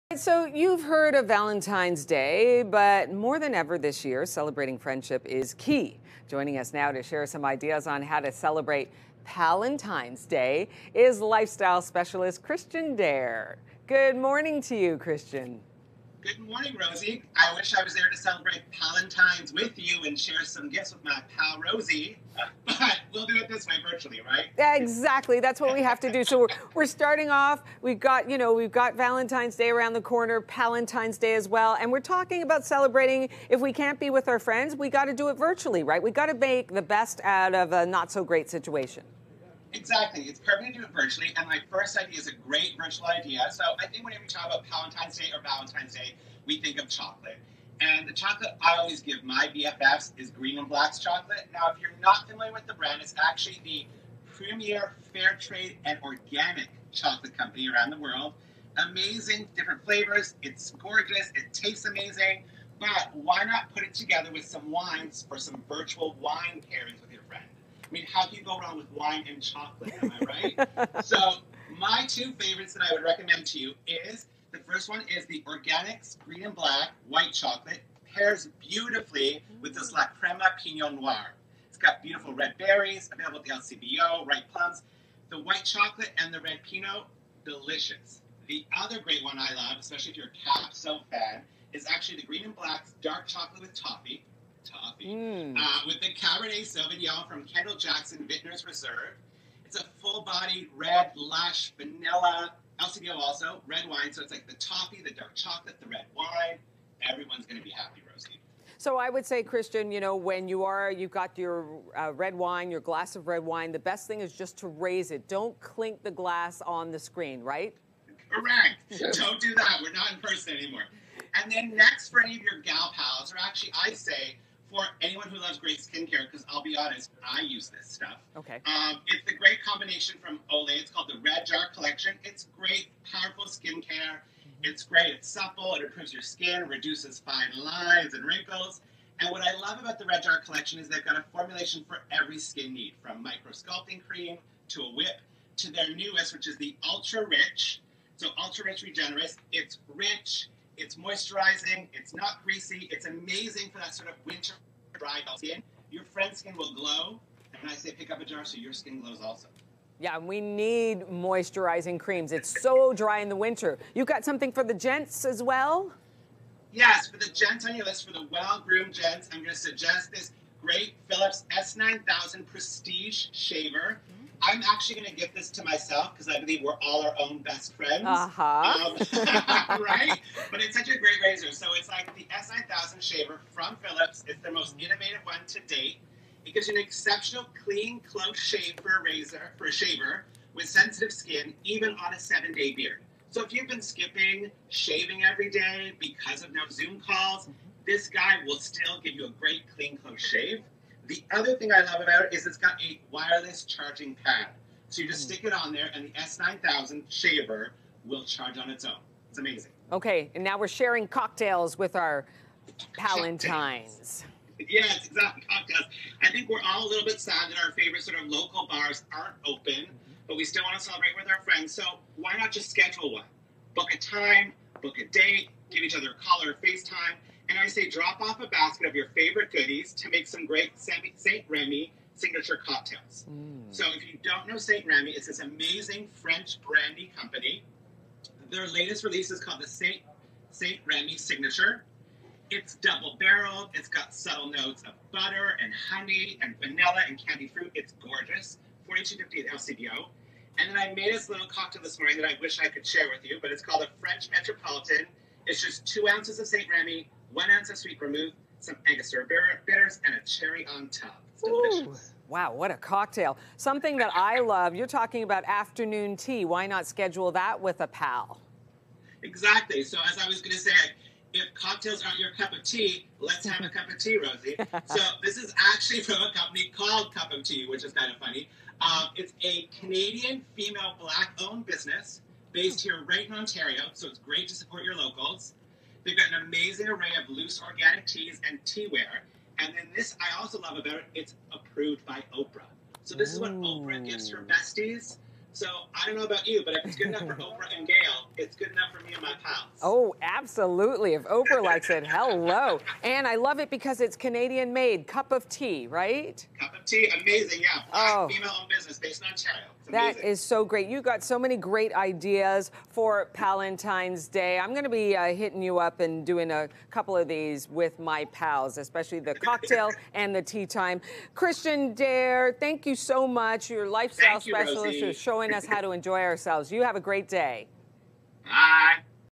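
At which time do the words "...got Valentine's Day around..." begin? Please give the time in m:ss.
0:28.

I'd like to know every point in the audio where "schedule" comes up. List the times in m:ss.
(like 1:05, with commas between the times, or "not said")
3:42, 4:26.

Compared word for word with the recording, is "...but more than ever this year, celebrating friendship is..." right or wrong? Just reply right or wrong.
right.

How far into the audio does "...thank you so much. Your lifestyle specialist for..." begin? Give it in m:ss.
5:22.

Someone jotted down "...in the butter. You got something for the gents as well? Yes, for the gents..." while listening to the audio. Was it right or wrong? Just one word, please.
wrong.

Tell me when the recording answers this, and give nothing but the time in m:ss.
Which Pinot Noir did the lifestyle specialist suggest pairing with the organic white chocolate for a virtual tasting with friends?
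1:19.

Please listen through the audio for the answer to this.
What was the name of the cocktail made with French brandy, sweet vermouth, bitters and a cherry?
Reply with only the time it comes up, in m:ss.
4:13.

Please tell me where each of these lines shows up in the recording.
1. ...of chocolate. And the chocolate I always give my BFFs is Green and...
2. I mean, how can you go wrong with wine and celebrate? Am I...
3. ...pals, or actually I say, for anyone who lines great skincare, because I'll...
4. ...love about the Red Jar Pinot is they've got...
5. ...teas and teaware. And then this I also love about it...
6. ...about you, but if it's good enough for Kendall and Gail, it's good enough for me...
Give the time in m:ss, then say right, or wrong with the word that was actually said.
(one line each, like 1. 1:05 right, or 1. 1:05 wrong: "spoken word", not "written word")
1. 0:46 right
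2. 1:07 wrong: "chocolate", not "celebrate"
3. 2:02 wrong: "loves", not "lines"
4. 2:19 wrong: "Collection", not "Pinot"
5. 4:48 right
6. 4:56 wrong: "Oprah", not "Kendall".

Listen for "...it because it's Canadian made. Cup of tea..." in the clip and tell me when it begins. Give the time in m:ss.
5:03.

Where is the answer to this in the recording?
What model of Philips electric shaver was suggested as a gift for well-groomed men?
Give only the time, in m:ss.
2:51.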